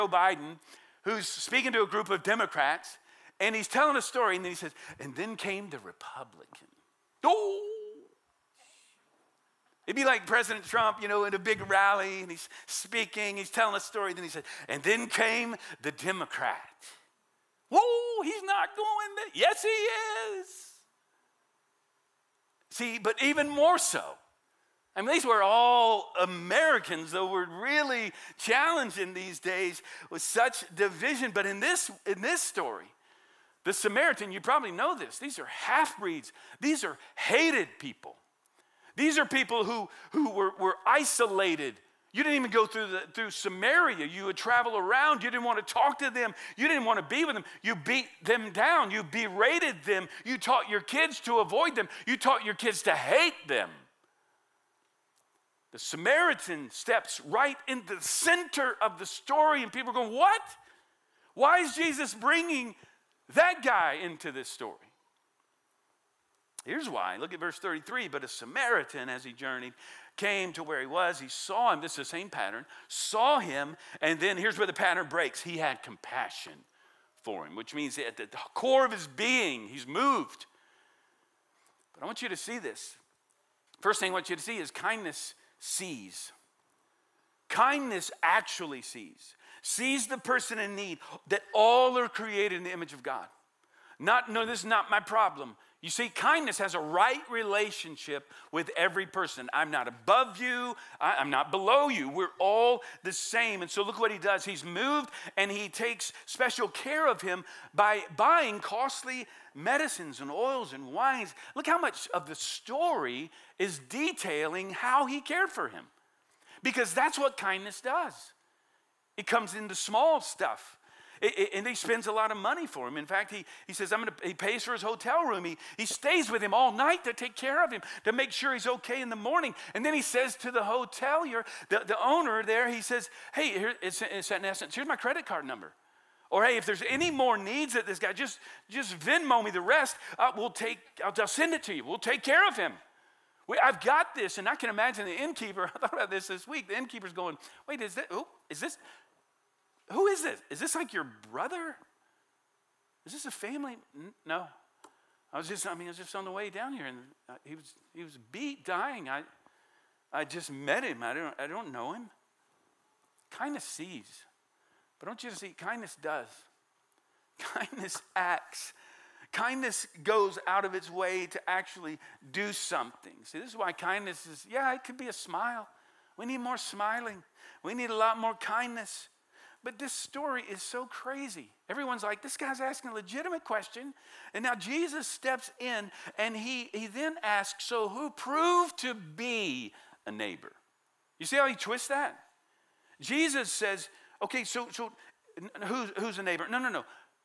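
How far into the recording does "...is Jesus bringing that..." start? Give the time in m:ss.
1:01.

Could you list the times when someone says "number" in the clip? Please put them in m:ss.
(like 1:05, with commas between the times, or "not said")
2:15.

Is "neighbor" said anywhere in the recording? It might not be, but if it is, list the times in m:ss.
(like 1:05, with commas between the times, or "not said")
3:10, 3:16.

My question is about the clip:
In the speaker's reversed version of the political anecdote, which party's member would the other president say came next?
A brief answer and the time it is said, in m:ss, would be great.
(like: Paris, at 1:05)
Democrat, at 0:15.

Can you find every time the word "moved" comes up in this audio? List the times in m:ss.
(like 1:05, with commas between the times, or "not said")
1:19, 1:44.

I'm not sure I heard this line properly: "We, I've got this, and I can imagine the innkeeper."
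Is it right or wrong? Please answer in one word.
right.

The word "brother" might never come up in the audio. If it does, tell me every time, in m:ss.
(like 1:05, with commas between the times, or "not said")
2:31.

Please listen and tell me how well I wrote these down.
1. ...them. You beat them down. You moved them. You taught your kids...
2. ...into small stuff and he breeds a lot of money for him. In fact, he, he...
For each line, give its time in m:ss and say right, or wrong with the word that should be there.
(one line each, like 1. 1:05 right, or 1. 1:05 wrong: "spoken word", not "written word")
1. 0:47 wrong: "berated", not "moved"
2. 1:59 wrong: "spends", not "breeds".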